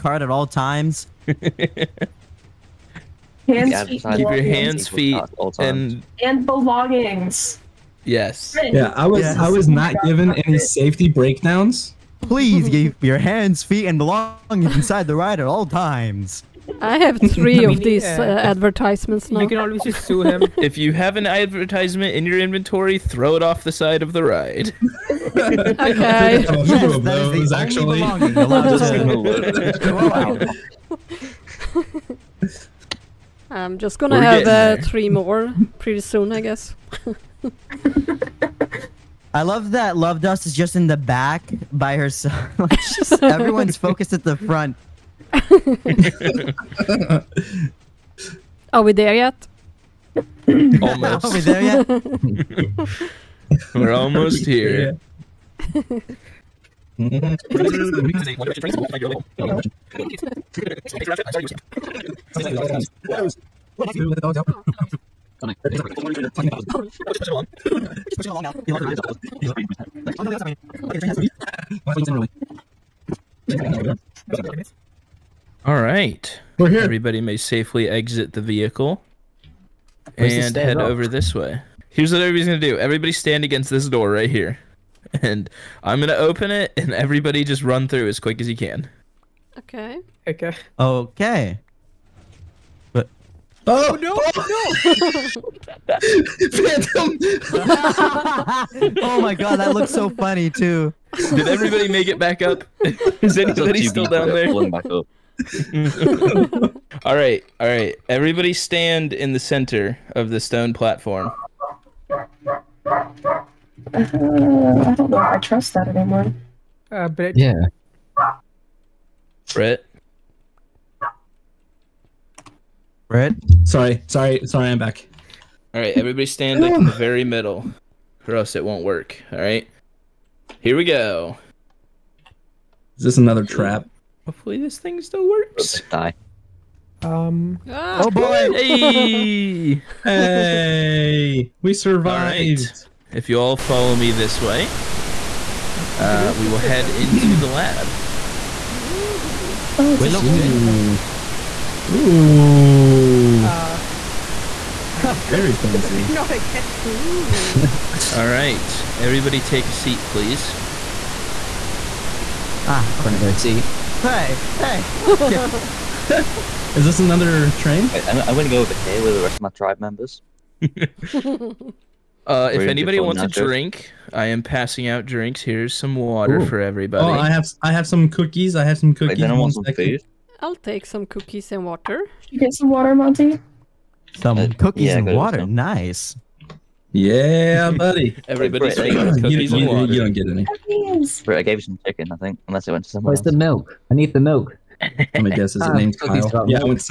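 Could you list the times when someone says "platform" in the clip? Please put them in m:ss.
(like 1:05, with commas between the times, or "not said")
1:50.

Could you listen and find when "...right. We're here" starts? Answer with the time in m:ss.
1:15.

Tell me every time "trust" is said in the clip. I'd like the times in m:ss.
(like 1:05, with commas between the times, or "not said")
1:55.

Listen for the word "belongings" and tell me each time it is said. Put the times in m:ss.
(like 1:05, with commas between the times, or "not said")
0:06, 0:13.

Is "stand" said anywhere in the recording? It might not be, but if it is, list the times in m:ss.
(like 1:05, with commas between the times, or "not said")
1:23, 1:48, 2:06.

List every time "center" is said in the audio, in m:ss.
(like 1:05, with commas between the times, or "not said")
1:49.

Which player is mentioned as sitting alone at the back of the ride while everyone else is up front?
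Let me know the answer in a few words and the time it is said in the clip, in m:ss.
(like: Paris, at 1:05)
Lovedust, at 0:39.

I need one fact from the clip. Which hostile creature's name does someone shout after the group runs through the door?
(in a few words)
Phantom.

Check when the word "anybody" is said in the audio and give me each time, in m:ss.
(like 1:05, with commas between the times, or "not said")
1:43, 2:52.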